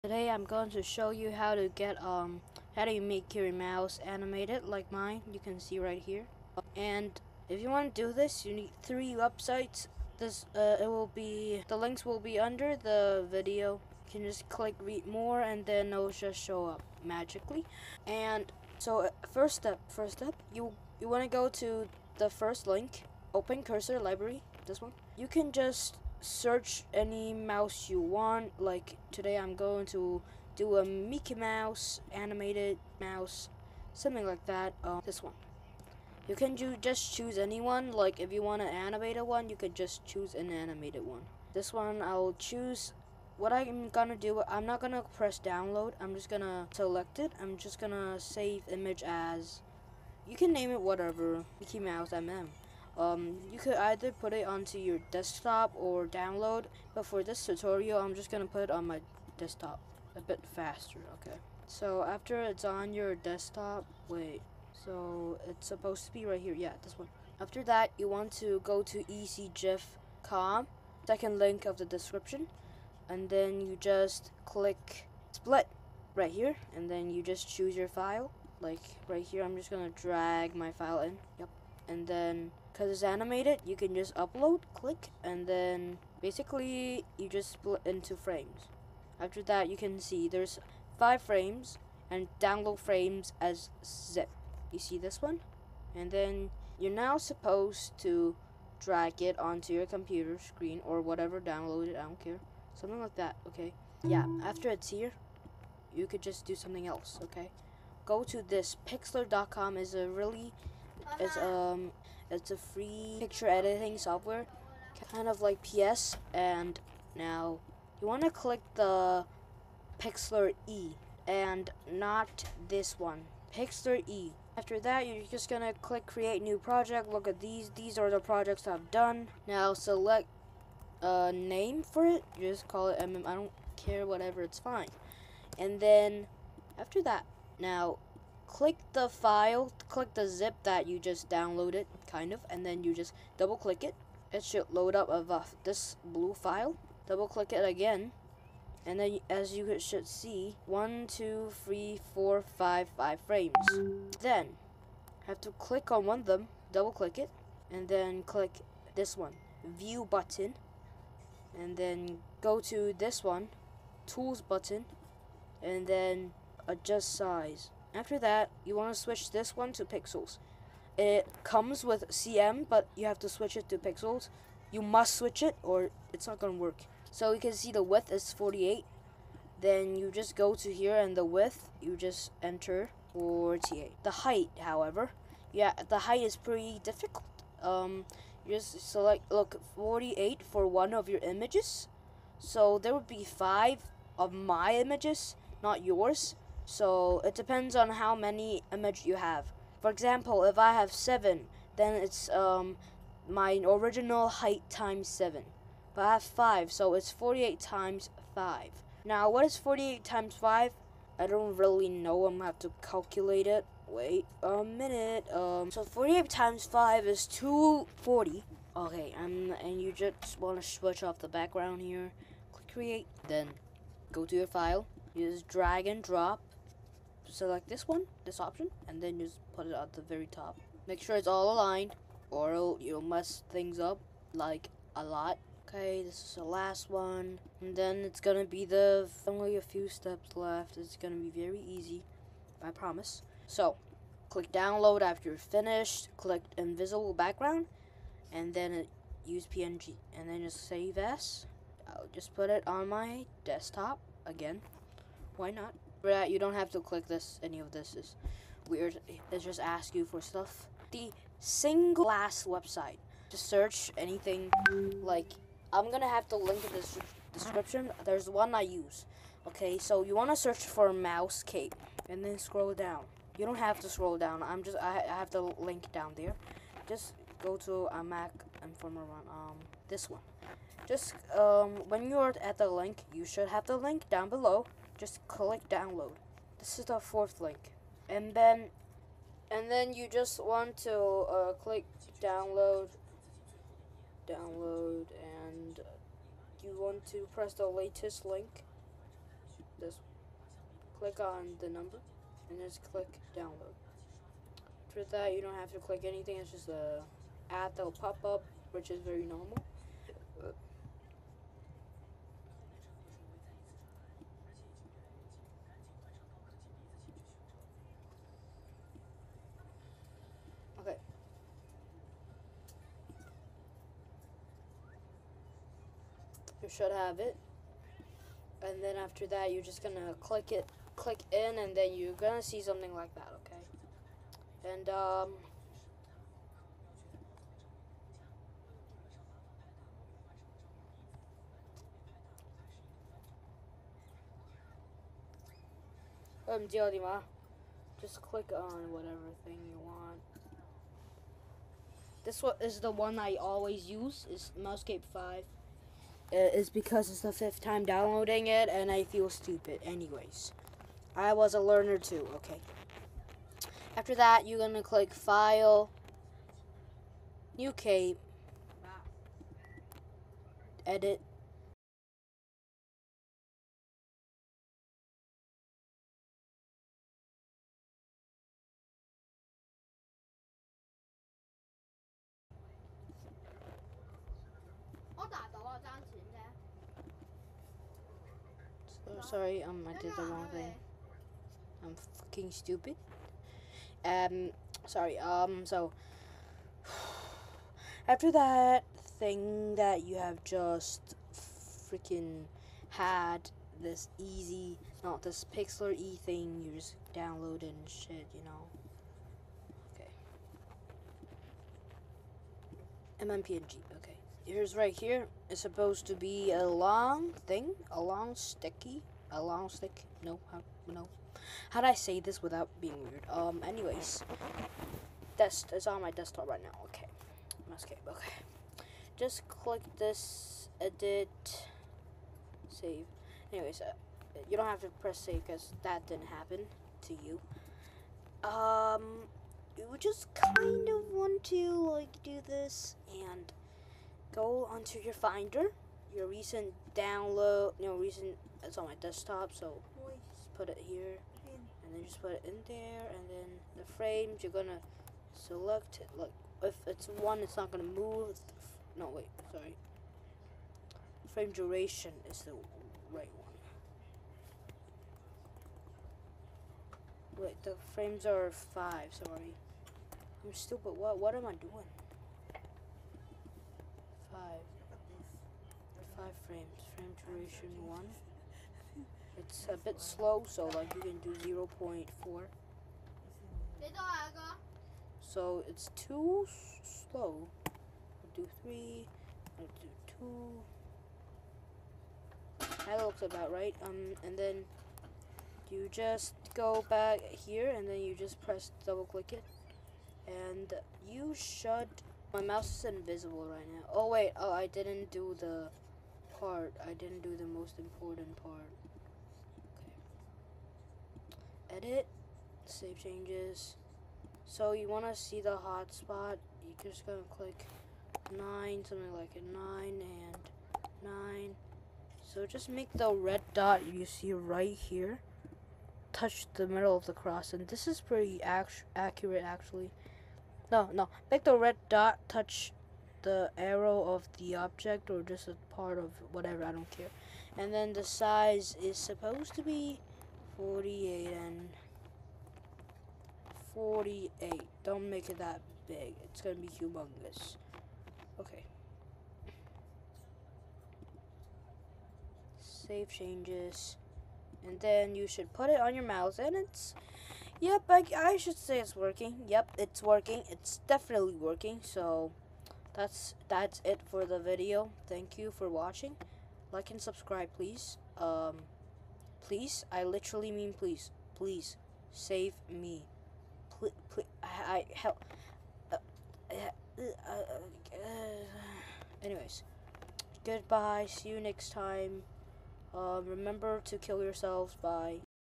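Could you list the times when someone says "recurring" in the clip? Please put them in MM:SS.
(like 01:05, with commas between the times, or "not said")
not said.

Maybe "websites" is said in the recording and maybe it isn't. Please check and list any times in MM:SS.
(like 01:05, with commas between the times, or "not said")
00:09, 04:22.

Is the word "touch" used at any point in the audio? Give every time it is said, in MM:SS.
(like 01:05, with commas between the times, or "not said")
08:46, 08:52.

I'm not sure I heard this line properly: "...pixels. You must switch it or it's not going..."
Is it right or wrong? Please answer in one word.
right.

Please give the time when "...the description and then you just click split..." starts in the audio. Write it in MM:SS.
01:11.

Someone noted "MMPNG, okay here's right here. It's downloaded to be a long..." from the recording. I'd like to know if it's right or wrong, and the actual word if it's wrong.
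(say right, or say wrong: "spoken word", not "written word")
wrong: "supposed", not "downloaded".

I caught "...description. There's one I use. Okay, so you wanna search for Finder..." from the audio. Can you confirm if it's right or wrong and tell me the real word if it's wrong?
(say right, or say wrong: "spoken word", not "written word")
wrong: "Mousecape", not "Finder".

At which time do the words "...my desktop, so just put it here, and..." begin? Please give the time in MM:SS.
07:28.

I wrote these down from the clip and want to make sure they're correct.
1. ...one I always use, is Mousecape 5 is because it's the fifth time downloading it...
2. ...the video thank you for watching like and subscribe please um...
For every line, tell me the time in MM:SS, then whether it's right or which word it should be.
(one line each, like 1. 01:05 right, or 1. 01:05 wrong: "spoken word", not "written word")
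1. 05:52 right
2. 09:24 right.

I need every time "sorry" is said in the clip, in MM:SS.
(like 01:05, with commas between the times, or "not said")
06:29, 06:34, 07:39, 07:49.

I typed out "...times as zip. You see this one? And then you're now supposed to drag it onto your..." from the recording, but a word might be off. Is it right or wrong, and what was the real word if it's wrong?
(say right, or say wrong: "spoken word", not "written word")
wrong: "frames", not "times".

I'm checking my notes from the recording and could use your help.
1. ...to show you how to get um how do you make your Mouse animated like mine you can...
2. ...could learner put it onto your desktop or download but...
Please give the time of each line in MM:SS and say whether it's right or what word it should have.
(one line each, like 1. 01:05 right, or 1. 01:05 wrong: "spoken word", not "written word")
1. 00:00 right
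2. 00:53 wrong: "either", not "learner".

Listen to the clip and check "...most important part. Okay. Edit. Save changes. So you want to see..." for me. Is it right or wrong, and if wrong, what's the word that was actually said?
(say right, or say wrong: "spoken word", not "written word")
right.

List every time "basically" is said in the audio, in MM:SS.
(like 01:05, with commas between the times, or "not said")
01:26.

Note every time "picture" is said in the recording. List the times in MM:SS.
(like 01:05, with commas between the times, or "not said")
01:53.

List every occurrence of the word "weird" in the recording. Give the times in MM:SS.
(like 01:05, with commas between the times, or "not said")
04:18, 07:03.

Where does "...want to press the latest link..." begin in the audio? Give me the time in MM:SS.
04:56.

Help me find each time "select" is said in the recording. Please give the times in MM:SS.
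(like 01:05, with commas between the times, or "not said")
00:46, 02:09, 03:08, 03:47, 07:35.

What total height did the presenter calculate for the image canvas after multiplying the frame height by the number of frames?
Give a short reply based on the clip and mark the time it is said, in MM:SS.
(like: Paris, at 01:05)
240, at 03:37.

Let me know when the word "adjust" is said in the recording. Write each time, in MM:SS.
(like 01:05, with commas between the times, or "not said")
02:46.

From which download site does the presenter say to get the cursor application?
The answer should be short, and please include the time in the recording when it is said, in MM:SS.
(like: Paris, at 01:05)
Mac Informer, at 04:38.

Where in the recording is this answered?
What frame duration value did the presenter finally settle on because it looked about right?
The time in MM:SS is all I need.
08:09.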